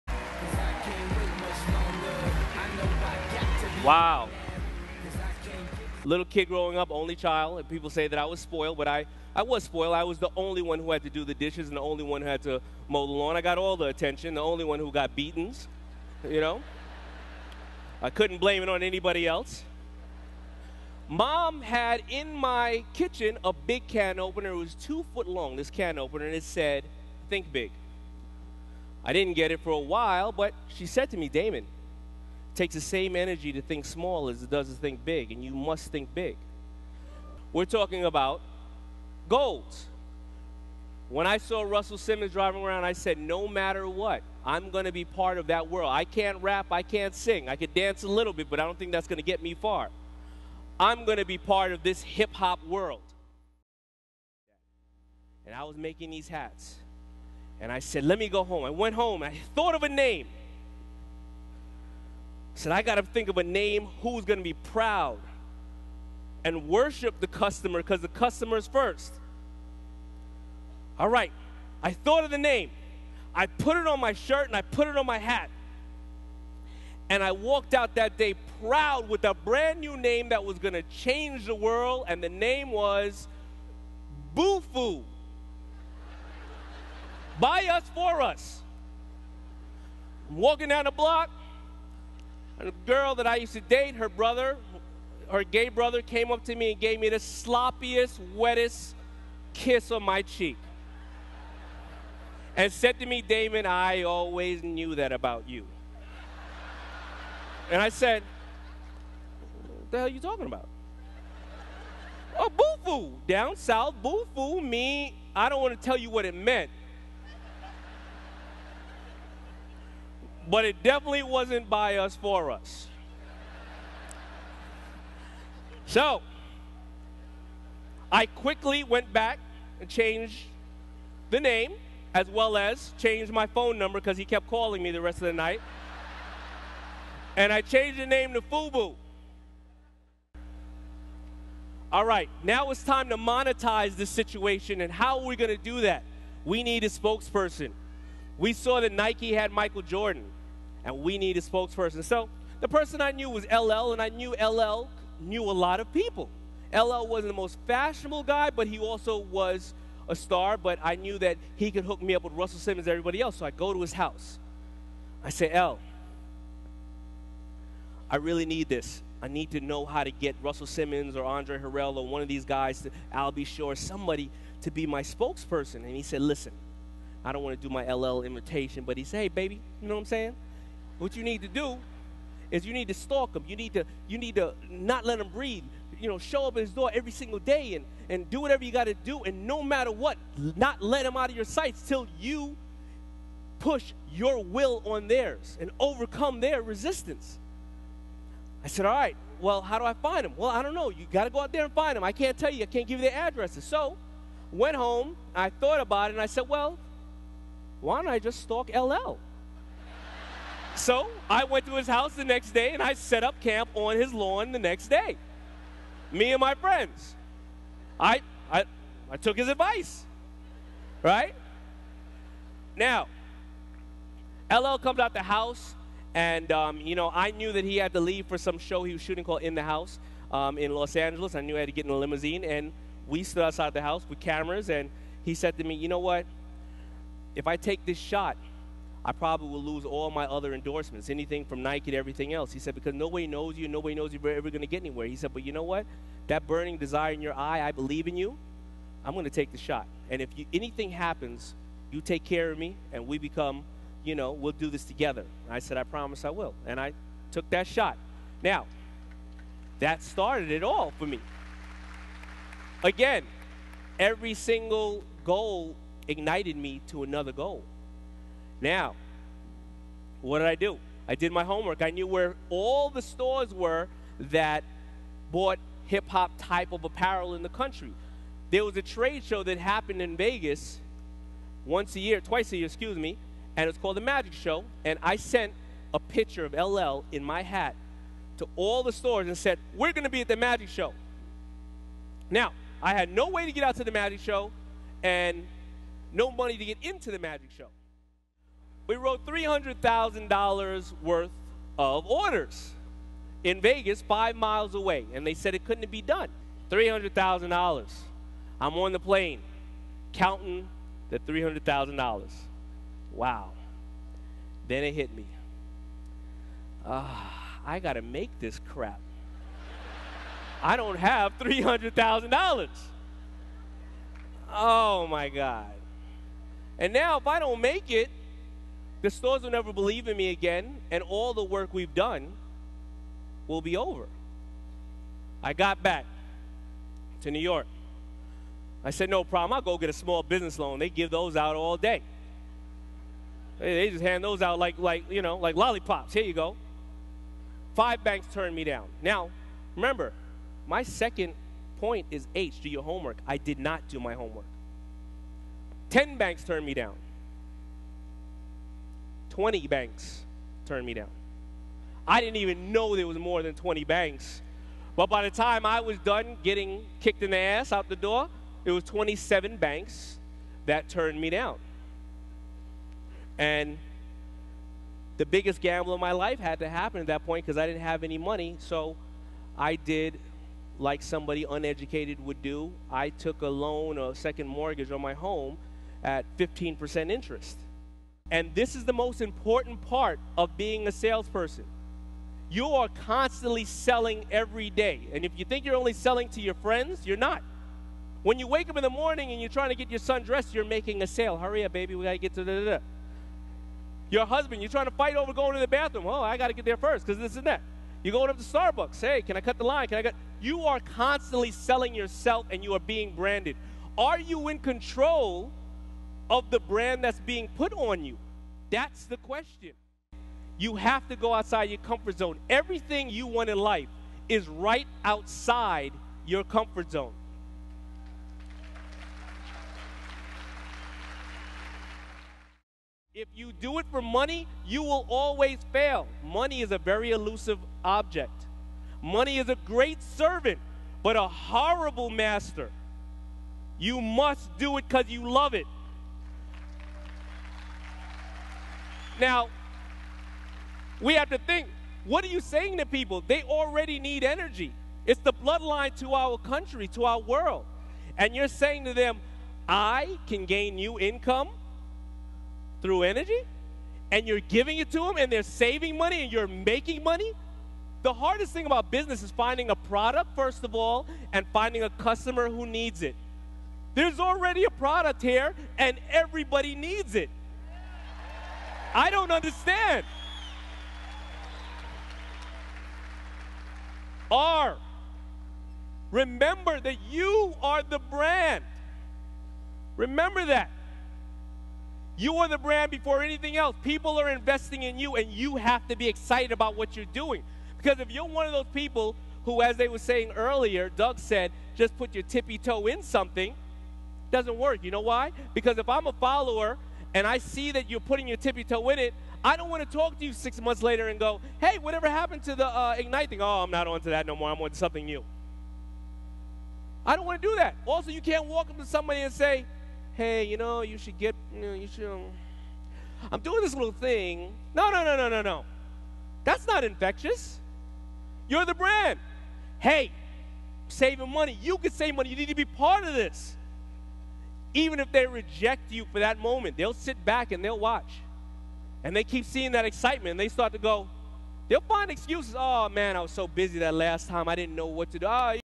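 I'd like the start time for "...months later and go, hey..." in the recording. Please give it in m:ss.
8:30.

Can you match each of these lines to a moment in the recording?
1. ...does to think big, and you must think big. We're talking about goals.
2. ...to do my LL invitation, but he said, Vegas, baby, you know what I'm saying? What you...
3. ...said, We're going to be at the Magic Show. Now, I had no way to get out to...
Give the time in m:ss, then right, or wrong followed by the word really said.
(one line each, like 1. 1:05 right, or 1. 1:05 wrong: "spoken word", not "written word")
1. 0:34 right
2. 2:57 wrong: "Hey", not "Vegas"
3. 4:49 right.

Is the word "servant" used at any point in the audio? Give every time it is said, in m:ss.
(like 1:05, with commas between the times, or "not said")
7:20.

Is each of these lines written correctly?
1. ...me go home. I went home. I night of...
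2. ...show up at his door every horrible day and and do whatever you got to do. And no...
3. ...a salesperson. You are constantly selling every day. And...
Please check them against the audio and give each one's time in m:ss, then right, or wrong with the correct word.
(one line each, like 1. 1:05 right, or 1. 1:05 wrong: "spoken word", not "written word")
1. 0:58 wrong: "thought", not "night"
2. 3:06 wrong: "single", not "horrible"
3. 6:30 right.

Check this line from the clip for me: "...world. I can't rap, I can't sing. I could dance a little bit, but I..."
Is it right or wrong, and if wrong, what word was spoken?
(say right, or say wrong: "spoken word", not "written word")
right.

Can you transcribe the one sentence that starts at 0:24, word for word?
It was two foot long, this can opener, and it said, Think big.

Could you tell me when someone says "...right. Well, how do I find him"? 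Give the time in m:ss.
3:18.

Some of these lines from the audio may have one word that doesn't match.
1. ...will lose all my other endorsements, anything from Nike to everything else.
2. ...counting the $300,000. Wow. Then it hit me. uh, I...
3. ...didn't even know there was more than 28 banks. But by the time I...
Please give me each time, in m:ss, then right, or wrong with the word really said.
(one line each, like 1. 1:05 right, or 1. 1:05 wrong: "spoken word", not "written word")
1. 3:59 right
2. 5:10 right
3. 6:02 wrong: "20", not "28".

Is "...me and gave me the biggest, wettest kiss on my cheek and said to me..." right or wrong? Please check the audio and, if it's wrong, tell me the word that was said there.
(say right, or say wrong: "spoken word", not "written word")
wrong: "sloppiest", not "biggest".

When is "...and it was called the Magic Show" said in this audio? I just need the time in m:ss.
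4:43.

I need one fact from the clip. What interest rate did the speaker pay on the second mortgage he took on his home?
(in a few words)
15%.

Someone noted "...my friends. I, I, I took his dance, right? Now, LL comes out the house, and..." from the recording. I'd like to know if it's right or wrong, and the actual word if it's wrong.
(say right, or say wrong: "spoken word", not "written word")
wrong: "advice", not "dance".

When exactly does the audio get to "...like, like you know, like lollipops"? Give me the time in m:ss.
5:44.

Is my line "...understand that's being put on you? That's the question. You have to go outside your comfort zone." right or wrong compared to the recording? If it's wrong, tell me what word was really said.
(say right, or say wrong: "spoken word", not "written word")
wrong: "brand", not "understand".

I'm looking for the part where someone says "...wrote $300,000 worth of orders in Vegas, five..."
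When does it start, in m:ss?
4:58.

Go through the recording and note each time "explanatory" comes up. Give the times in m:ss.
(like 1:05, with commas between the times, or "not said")
not said.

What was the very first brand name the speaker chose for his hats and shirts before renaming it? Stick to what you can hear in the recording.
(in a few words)
BUFU.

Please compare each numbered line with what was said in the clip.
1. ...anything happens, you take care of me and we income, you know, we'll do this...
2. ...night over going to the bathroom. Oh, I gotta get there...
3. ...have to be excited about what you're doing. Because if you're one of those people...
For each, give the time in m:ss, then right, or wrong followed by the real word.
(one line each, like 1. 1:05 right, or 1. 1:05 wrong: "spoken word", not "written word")
1. 4:10 wrong: "become", not "income"
2. 6:44 wrong: "fight", not "night"
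3. 8:15 right.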